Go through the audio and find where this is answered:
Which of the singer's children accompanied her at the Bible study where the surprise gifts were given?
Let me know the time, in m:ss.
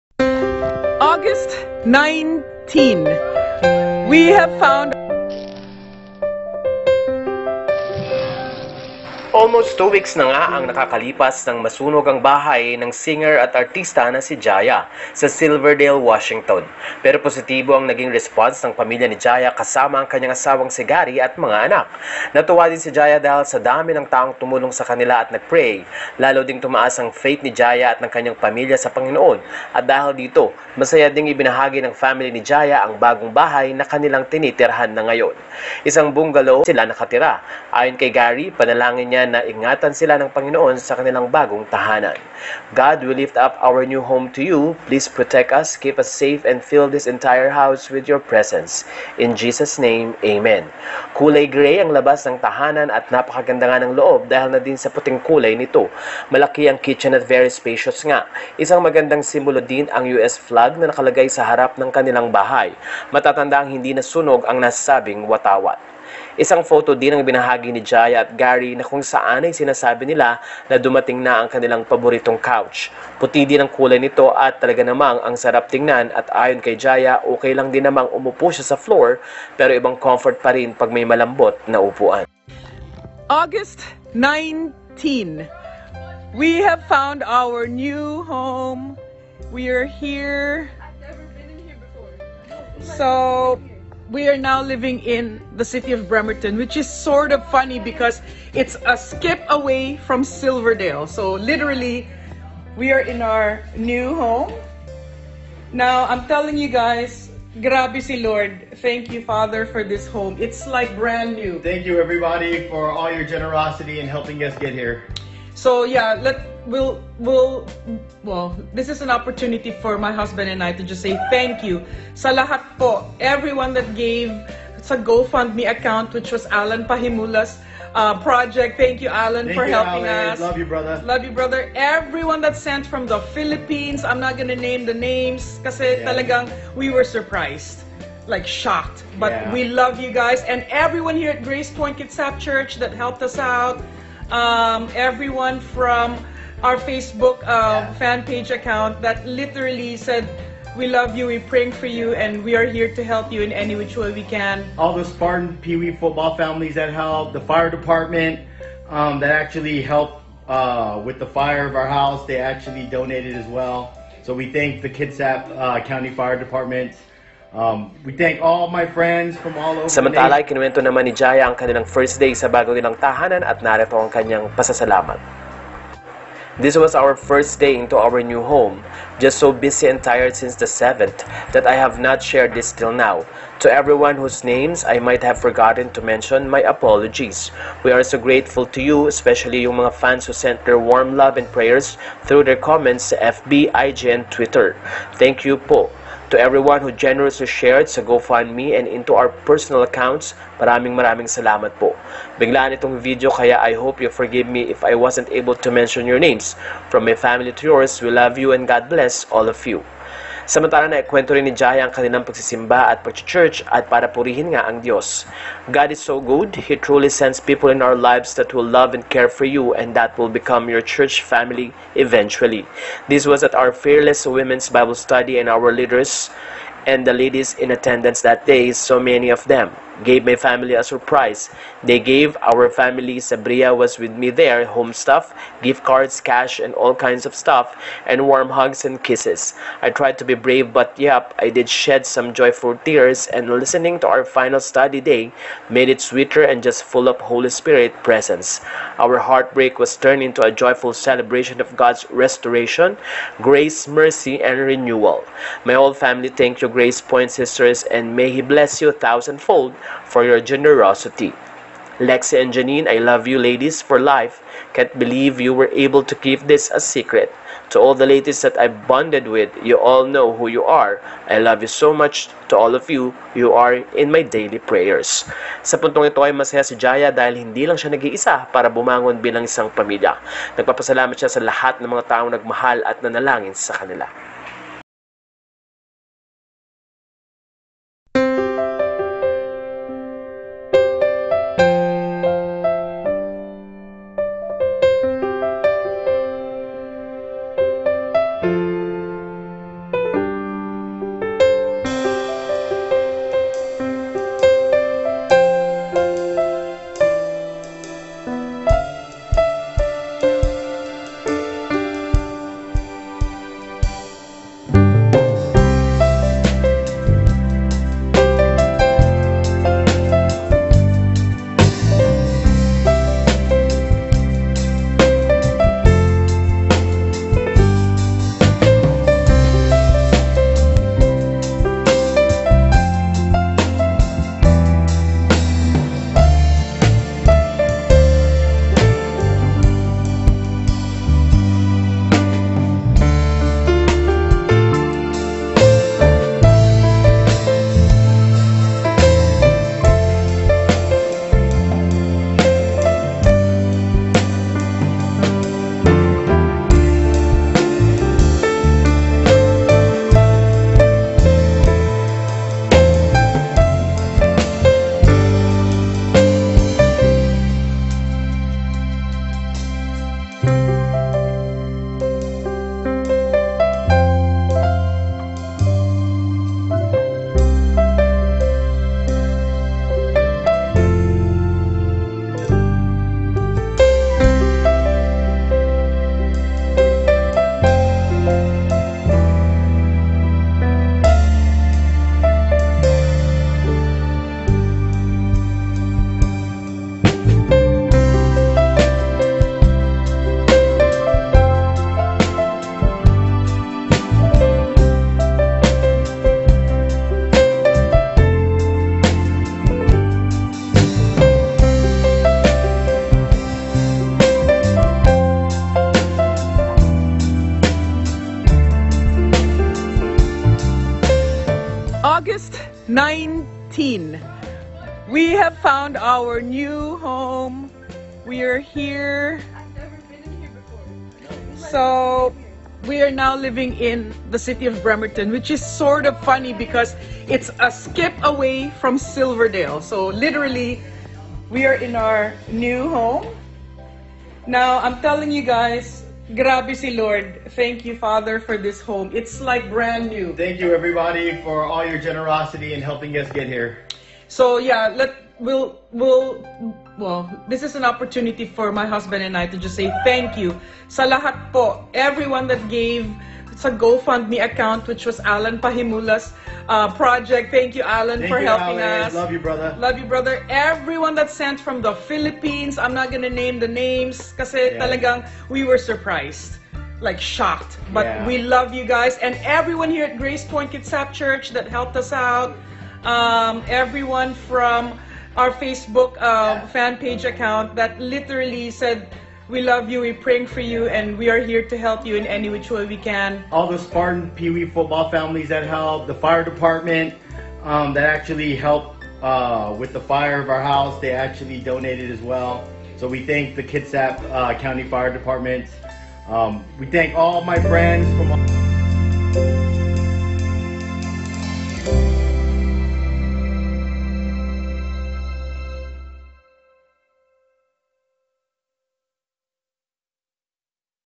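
3:53.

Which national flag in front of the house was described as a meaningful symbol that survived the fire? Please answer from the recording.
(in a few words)
US flag.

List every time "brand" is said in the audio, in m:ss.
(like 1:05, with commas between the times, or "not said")
1:50, 7:29.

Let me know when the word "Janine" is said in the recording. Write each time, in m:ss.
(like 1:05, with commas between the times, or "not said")
4:22.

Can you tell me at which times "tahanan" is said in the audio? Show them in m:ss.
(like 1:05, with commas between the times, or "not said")
0:41, 0:52, 2:53.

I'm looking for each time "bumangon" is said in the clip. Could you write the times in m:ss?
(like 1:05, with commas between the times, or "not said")
4:38.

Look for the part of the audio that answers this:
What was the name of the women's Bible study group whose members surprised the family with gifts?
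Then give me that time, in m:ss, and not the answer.
3:43.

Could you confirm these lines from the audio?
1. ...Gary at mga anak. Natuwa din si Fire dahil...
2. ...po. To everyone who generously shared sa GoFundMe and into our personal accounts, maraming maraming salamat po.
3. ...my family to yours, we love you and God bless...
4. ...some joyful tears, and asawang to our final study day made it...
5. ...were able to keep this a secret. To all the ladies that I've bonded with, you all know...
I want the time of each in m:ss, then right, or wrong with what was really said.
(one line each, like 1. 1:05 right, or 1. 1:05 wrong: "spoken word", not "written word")
1. 0:20 wrong: "Jaya", not "Fire"
2. 3:15 right
3. 3:27 right
4. 4:02 wrong: "listening", not "asawang"
5. 4:25 right.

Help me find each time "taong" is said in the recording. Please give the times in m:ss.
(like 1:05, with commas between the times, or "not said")
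0:24, 4:42.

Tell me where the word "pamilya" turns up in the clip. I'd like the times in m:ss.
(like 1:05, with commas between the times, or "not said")
0:18, 0:28, 4:39.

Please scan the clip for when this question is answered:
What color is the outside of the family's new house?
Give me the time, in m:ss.
0:51.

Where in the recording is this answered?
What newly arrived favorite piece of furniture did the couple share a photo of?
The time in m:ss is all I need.
1:12.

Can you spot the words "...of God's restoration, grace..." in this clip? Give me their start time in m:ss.
4:11.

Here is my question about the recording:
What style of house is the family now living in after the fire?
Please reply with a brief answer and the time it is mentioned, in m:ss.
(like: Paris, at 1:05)
Bungalow, at 0:36.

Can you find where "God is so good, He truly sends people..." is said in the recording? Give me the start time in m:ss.
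3:35.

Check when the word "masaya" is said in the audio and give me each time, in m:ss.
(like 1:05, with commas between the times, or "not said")
0:30, 4:36.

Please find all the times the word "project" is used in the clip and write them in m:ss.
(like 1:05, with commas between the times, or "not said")
2:08, 7:46.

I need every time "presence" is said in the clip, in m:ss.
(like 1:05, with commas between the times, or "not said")
0:48, 4:08.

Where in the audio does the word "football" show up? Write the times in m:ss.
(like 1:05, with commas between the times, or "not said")
2:35, 8:14.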